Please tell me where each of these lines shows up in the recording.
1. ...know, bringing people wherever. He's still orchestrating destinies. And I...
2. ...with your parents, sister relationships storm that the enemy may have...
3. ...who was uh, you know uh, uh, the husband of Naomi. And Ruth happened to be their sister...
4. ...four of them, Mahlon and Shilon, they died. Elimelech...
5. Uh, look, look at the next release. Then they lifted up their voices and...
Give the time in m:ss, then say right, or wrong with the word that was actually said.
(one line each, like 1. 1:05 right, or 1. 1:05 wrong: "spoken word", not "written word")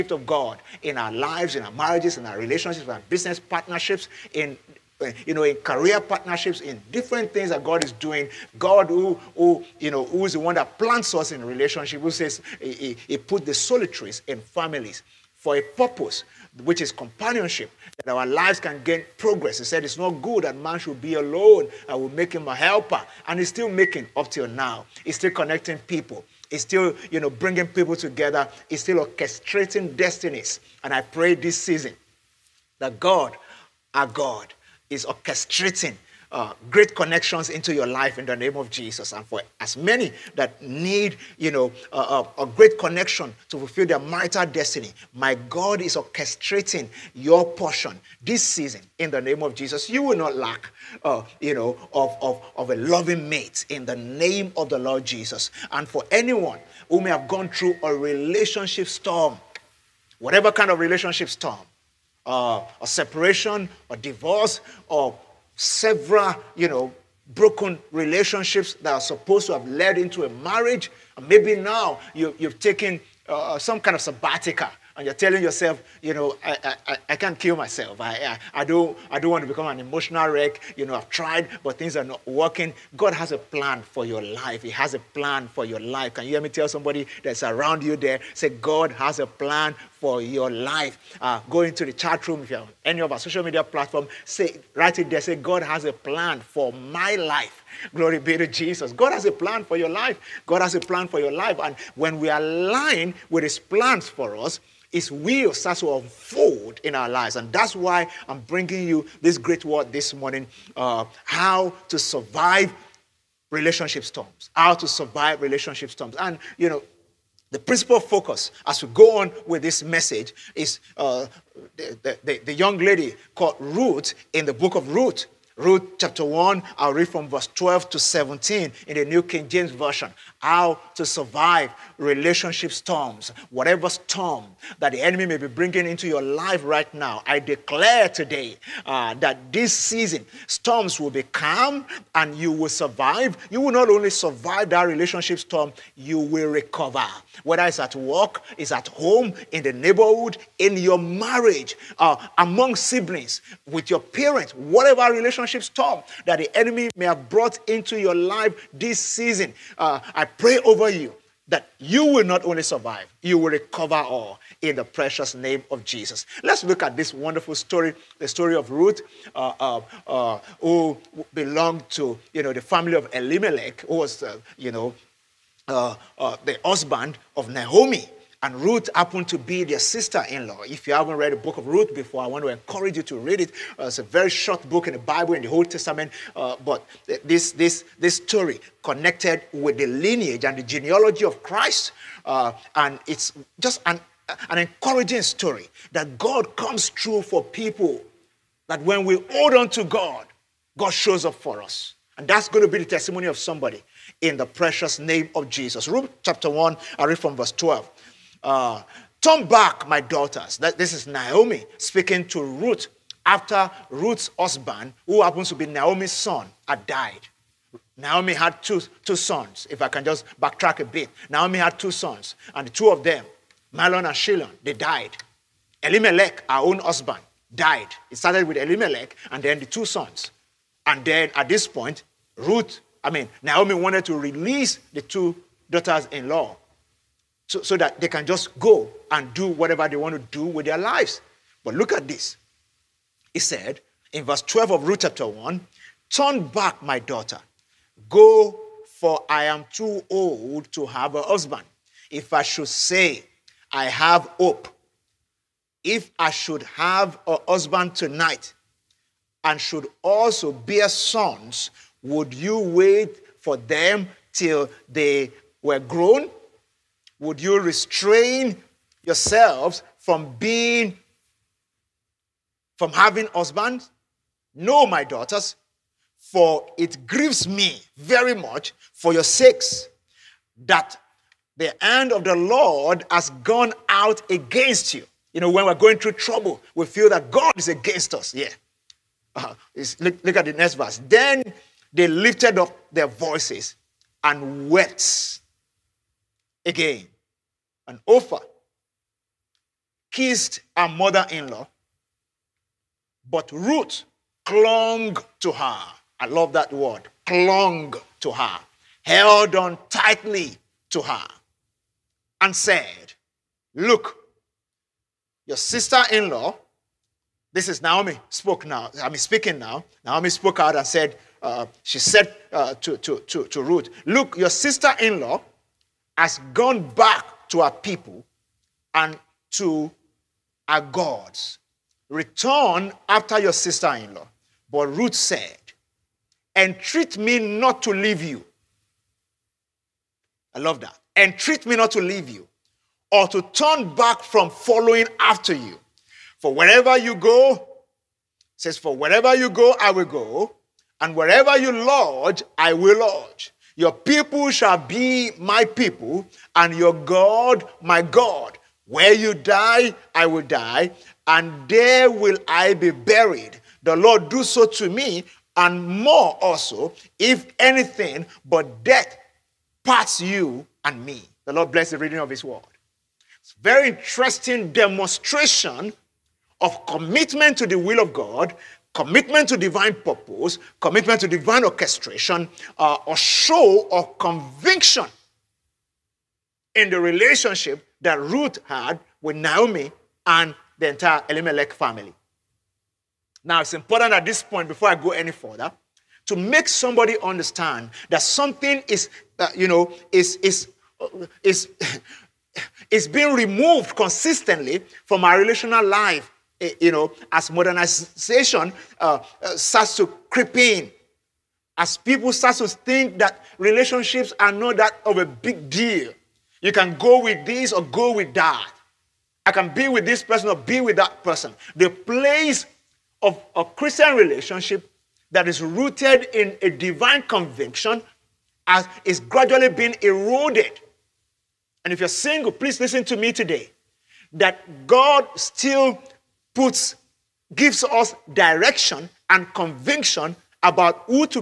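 1. 0:27 wrong: "together", not "wherever"
2. 2:33 wrong: "whatever", not "sister"
3. 2:53 right
4. 3:42 wrong: "two", not "four"
5. 4:49 wrong: "verse", not "release".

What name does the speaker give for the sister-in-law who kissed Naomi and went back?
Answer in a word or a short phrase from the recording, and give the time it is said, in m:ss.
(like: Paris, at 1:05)
Ophir, at 4:58.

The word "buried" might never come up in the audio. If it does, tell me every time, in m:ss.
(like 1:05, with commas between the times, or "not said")
6:02.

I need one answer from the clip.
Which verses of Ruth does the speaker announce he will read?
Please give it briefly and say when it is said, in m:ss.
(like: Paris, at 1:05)
Verse 12 to 17, at 2:07.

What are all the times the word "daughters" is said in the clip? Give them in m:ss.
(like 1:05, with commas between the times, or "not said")
3:29, 3:55, 4:06, 4:35.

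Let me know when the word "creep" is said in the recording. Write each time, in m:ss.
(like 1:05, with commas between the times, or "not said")
6:50.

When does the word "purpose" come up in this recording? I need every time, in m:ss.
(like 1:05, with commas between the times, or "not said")
0:15, 6:19.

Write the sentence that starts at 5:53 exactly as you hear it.
Your people shall be my people, and your God my God.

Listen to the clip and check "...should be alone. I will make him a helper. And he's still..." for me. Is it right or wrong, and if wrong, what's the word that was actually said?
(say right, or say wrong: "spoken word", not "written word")
right.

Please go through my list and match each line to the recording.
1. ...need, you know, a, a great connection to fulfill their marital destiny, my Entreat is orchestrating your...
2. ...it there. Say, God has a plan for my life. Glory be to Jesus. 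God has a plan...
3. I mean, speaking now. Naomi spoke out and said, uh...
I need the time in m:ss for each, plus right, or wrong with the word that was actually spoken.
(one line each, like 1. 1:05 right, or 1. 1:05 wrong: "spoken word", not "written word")
1. 0:40 wrong: "God", not "Entreat"
2. 1:34 right
3. 5:19 right.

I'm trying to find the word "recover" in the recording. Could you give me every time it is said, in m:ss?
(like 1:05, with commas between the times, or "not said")
2:26, 2:43.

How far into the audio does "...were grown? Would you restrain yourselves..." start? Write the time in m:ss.
4:25.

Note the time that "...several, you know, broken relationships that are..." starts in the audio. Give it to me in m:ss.
1:05.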